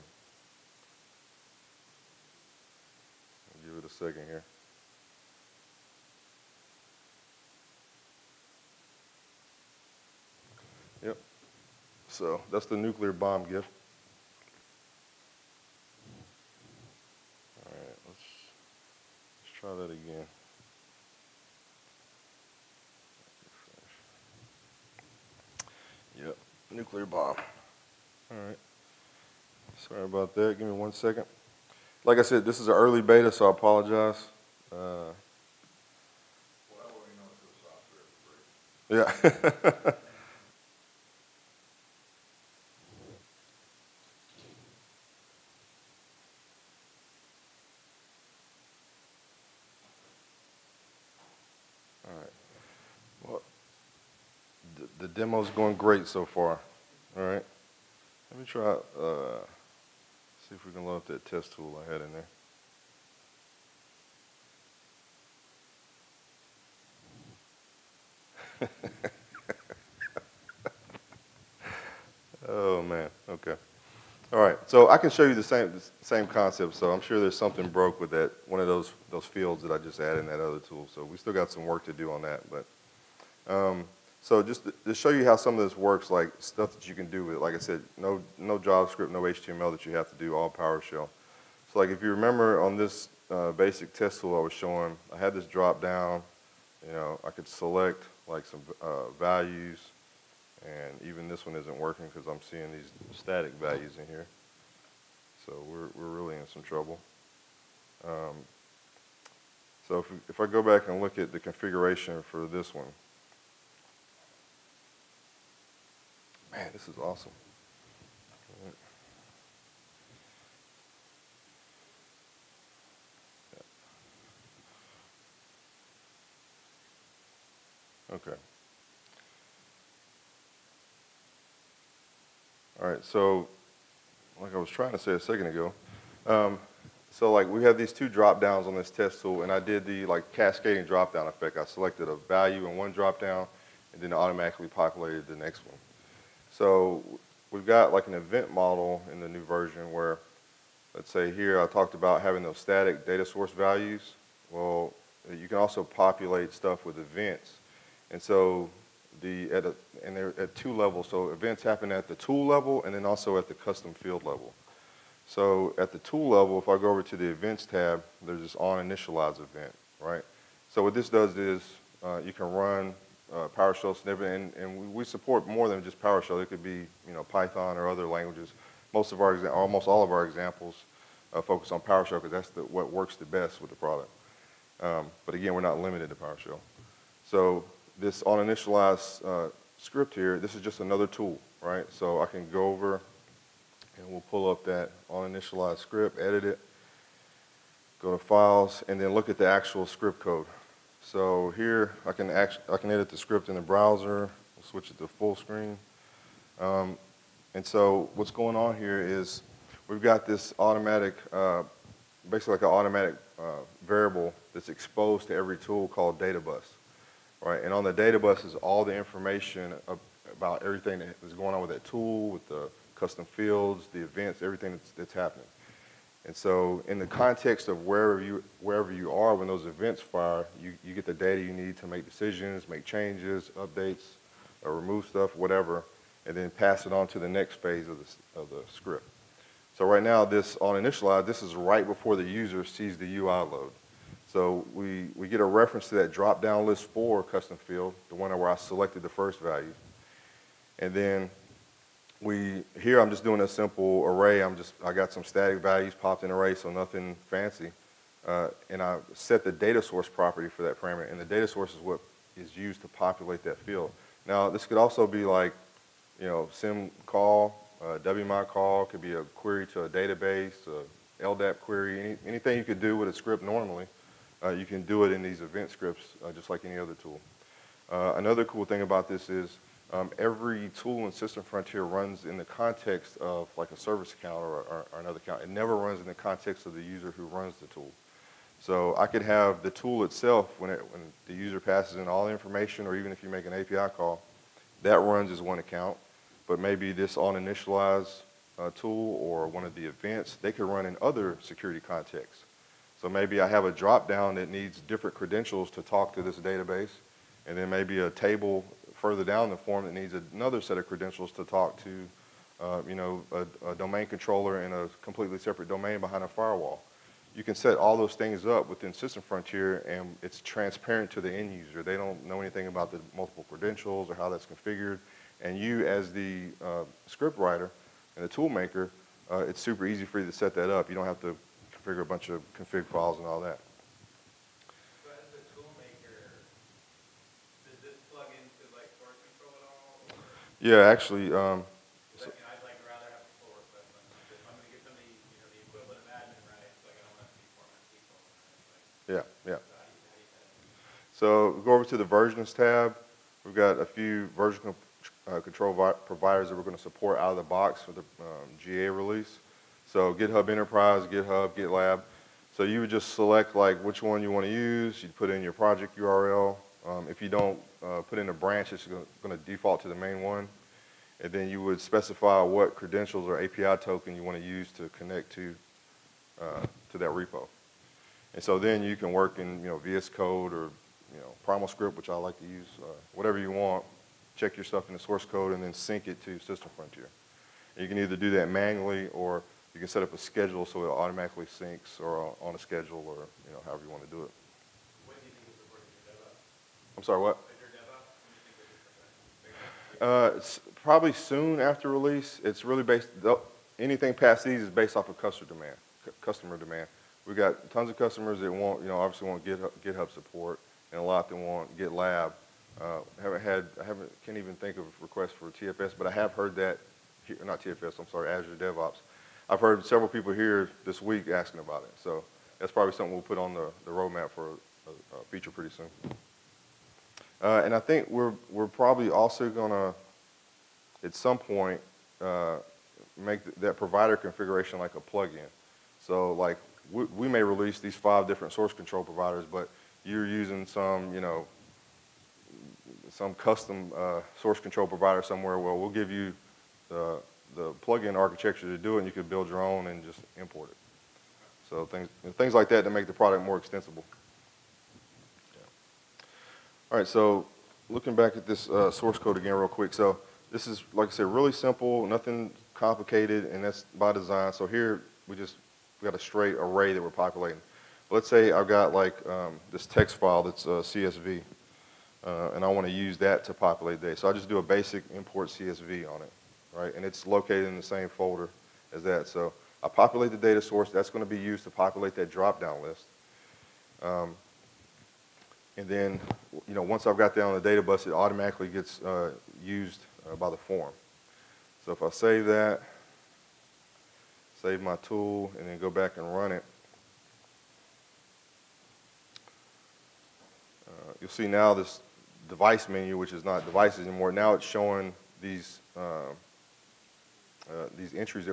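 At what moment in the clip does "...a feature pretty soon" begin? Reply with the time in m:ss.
7:05.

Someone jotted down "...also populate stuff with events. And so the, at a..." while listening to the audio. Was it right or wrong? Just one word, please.
right.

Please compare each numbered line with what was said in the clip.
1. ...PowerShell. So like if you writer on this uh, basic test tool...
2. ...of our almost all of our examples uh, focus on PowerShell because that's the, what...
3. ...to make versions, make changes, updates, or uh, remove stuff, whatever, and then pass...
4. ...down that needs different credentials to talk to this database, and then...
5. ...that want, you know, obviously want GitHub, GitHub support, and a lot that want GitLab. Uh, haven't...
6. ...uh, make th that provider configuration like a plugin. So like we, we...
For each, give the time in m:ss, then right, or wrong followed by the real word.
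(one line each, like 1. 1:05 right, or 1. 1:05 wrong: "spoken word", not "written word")
1. 1:30 wrong: "remember", not "writer"
2. 2:59 right
3. 3:51 wrong: "decisions", not "versions"
4. 5:04 right
5. 6:48 right
6. 7:12 right.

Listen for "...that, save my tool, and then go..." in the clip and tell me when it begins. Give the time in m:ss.
8:12.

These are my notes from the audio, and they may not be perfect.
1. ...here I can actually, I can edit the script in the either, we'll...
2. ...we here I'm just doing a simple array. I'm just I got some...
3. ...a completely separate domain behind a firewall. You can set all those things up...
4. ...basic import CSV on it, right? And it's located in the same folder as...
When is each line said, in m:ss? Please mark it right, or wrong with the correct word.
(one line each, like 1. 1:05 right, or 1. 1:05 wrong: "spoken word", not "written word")
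1. 3:21 wrong: "browser", not "either"
2. 4:12 right
3. 5:14 right
4. 7:54 right.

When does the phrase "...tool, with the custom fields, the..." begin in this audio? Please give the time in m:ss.
3:41.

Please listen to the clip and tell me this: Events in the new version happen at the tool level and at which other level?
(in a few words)
custom field level.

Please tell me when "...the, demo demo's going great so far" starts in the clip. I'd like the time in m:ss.
0:54.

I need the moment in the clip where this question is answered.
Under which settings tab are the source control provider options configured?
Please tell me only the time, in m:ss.
5:52.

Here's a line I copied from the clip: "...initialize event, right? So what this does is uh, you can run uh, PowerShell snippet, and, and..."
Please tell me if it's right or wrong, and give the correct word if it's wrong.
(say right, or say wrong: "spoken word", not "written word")
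right.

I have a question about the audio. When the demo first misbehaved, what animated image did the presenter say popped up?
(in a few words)
nuclear bomb gif.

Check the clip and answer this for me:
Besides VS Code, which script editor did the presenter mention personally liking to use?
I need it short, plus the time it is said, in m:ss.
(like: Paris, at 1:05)
PrimalScript, at 6:21.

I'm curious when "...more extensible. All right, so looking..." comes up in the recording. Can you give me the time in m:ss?
7:33.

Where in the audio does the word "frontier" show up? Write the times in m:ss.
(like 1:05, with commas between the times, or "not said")
4:41, 5:19, 6:26.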